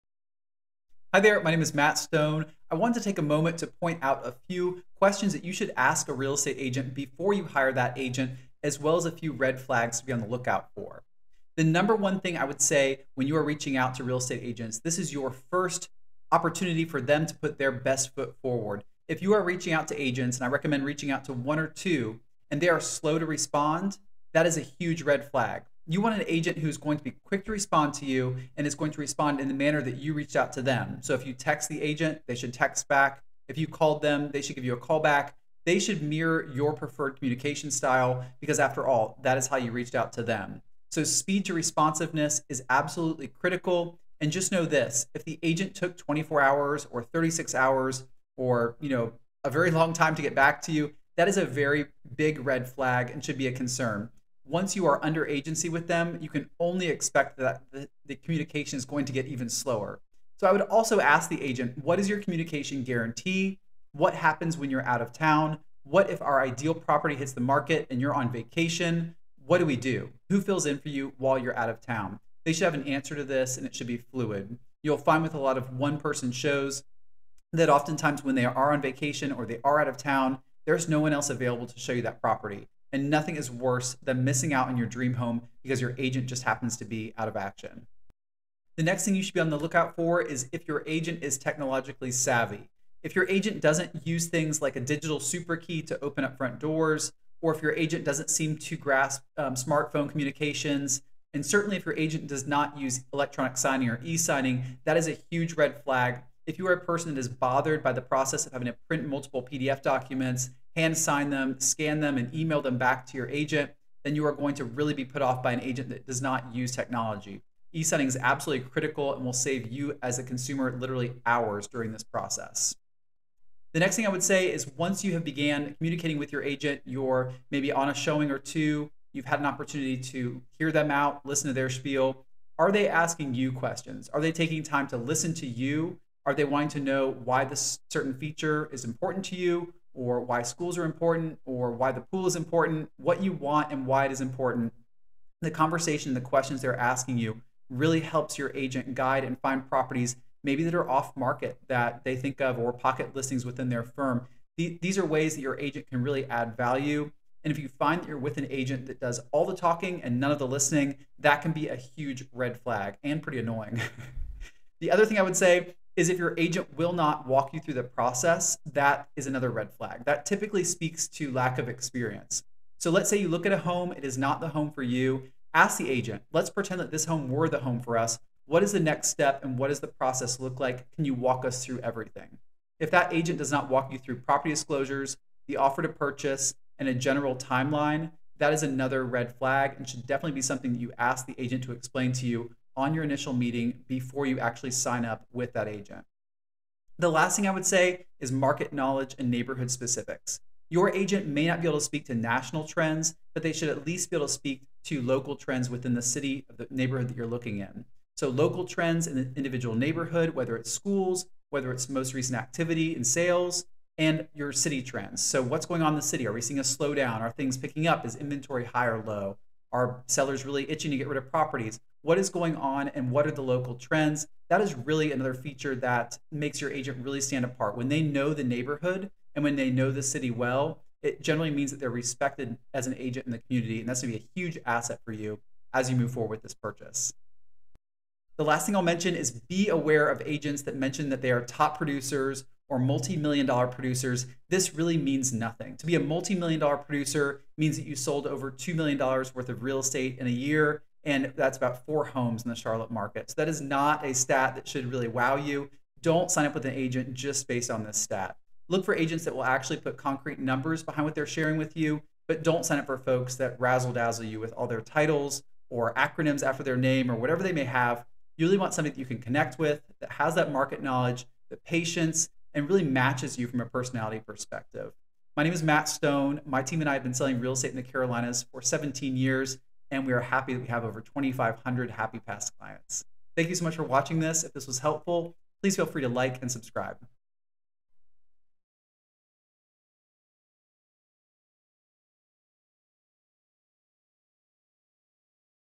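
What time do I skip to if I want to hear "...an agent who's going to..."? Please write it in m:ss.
0:26.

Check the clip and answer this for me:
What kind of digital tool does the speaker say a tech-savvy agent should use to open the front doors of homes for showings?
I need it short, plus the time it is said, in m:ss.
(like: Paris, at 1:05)
digital super key, at 1:34.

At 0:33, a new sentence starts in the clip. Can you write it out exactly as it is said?
If you called them, they should give you a call back.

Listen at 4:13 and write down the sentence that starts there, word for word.
So that is not a stat that should really wow you.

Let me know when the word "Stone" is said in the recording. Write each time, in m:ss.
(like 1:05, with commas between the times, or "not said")
0:01, 4:35.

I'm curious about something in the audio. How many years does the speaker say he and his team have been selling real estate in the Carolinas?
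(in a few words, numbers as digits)
17.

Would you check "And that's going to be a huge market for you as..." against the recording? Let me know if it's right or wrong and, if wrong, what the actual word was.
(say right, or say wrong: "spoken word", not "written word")
wrong: "asset", not "market".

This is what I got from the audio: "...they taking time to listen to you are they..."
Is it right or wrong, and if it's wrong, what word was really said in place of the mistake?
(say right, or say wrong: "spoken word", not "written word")
right.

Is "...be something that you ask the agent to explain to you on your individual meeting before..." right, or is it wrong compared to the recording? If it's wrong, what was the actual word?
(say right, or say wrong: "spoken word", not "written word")
wrong: "initial", not "individual".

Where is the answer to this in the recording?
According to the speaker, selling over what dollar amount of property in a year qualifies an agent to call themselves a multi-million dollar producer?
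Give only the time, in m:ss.
4:08.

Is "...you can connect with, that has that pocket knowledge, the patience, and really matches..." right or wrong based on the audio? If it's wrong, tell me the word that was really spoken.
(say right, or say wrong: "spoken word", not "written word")
wrong: "market", not "pocket".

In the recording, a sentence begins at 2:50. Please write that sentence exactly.
That typically speaks to lack of experience.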